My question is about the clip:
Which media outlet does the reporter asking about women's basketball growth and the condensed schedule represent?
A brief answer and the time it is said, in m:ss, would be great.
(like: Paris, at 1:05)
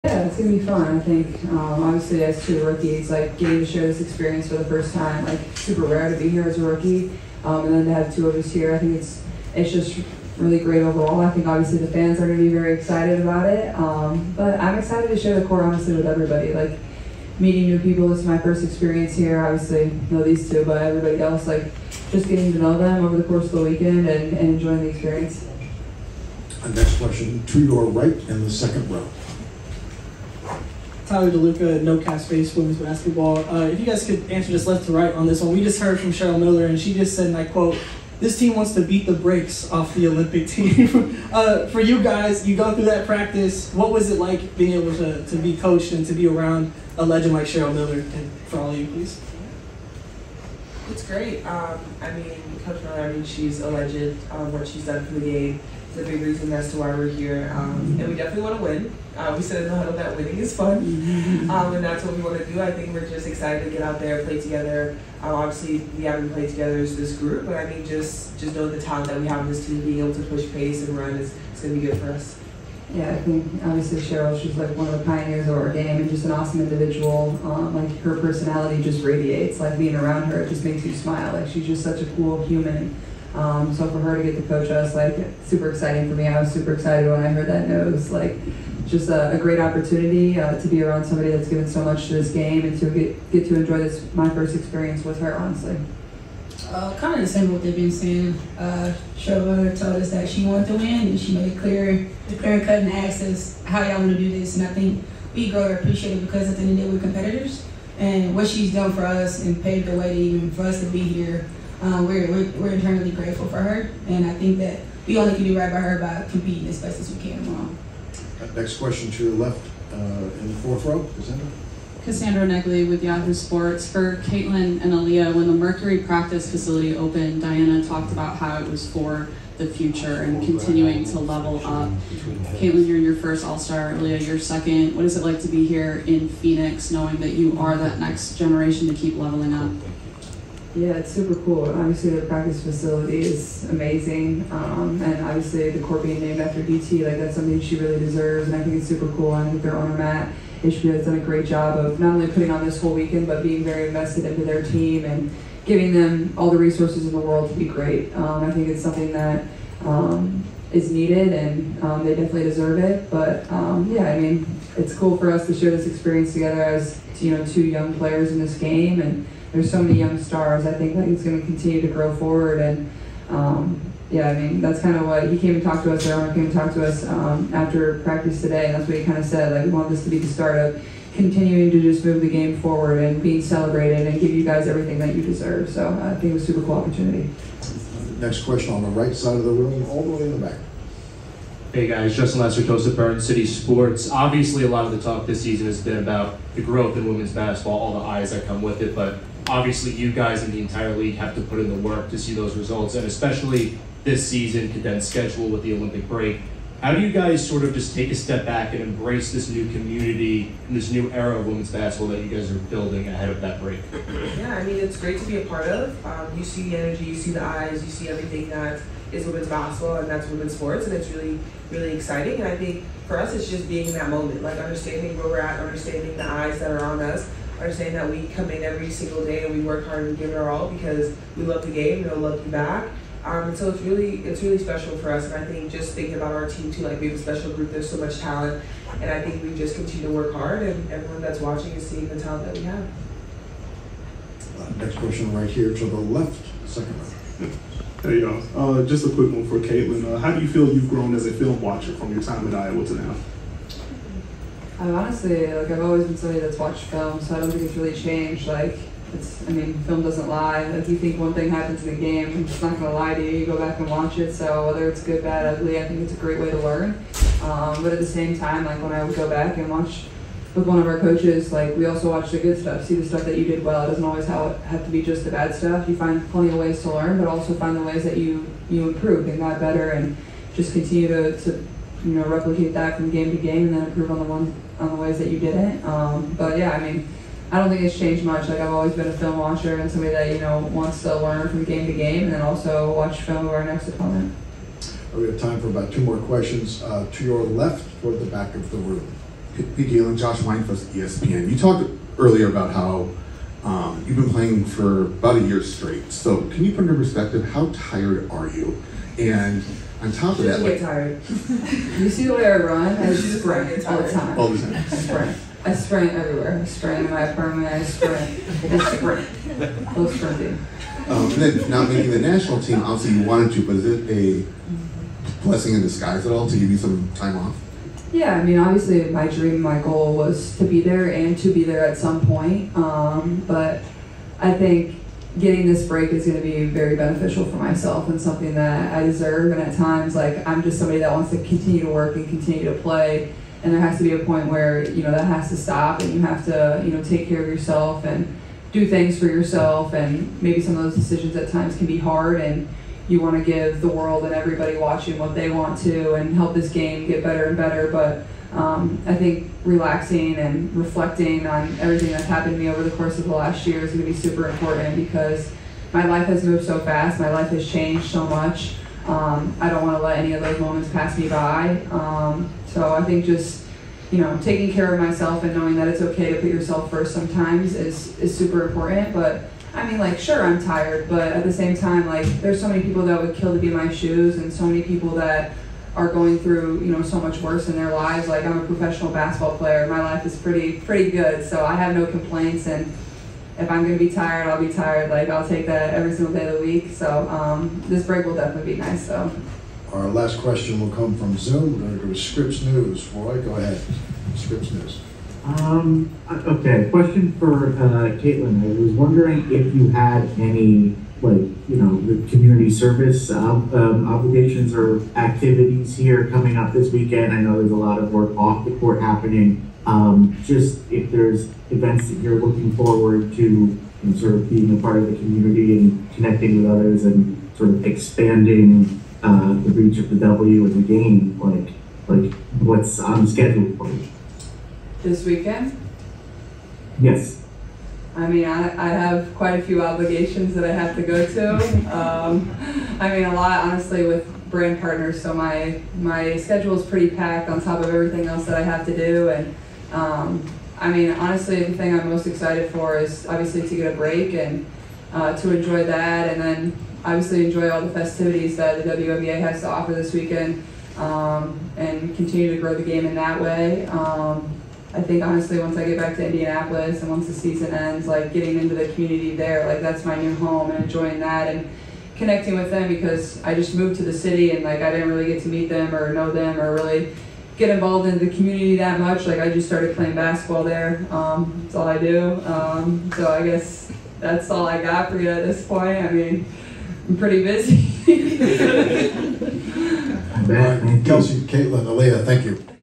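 Burn City Sports, at 3:12.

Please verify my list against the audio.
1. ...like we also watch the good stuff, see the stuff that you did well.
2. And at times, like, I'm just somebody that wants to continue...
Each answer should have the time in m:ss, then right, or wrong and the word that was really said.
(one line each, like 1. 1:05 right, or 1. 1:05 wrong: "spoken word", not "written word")
1. 4:31 right
2. 5:39 right.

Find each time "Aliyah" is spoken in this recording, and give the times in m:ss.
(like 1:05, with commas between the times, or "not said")
2:04, 2:13, 8:11.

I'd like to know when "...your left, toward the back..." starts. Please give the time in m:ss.
4:57.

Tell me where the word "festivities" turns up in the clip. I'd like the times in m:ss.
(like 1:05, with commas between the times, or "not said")
7:37.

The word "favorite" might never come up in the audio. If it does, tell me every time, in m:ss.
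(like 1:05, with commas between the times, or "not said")
not said.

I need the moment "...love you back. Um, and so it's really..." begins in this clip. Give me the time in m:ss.
3:52.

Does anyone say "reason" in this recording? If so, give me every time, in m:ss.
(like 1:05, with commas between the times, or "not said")
0:56.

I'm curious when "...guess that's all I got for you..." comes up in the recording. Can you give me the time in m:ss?
8:03.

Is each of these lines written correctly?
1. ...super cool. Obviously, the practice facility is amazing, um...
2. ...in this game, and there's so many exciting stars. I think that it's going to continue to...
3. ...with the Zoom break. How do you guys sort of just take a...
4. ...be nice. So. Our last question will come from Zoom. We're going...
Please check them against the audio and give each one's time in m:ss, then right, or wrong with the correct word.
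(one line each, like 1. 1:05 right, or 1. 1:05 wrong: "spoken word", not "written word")
1. 2:21 right
2. 2:48 wrong: "young", not "exciting"
3. 3:25 wrong: "Olympic", not "Zoom"
4. 6:38 right.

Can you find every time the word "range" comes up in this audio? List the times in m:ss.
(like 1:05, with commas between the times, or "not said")
not said.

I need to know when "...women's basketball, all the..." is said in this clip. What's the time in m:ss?
3:17.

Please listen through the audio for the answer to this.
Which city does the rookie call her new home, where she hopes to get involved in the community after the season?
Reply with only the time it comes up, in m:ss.
7:46.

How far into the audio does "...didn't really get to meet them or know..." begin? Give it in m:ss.
7:54.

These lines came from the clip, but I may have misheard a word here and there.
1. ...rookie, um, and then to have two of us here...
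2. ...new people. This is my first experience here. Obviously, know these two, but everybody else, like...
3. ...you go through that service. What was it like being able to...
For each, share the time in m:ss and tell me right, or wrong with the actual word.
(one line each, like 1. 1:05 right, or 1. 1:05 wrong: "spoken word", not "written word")
1. 0:06 right
2. 0:17 right
3. 0:42 wrong: "practice", not "service".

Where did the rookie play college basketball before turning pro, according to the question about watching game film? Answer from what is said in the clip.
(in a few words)
Iowa.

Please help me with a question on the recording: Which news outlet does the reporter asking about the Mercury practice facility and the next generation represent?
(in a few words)
Yahoo Sports.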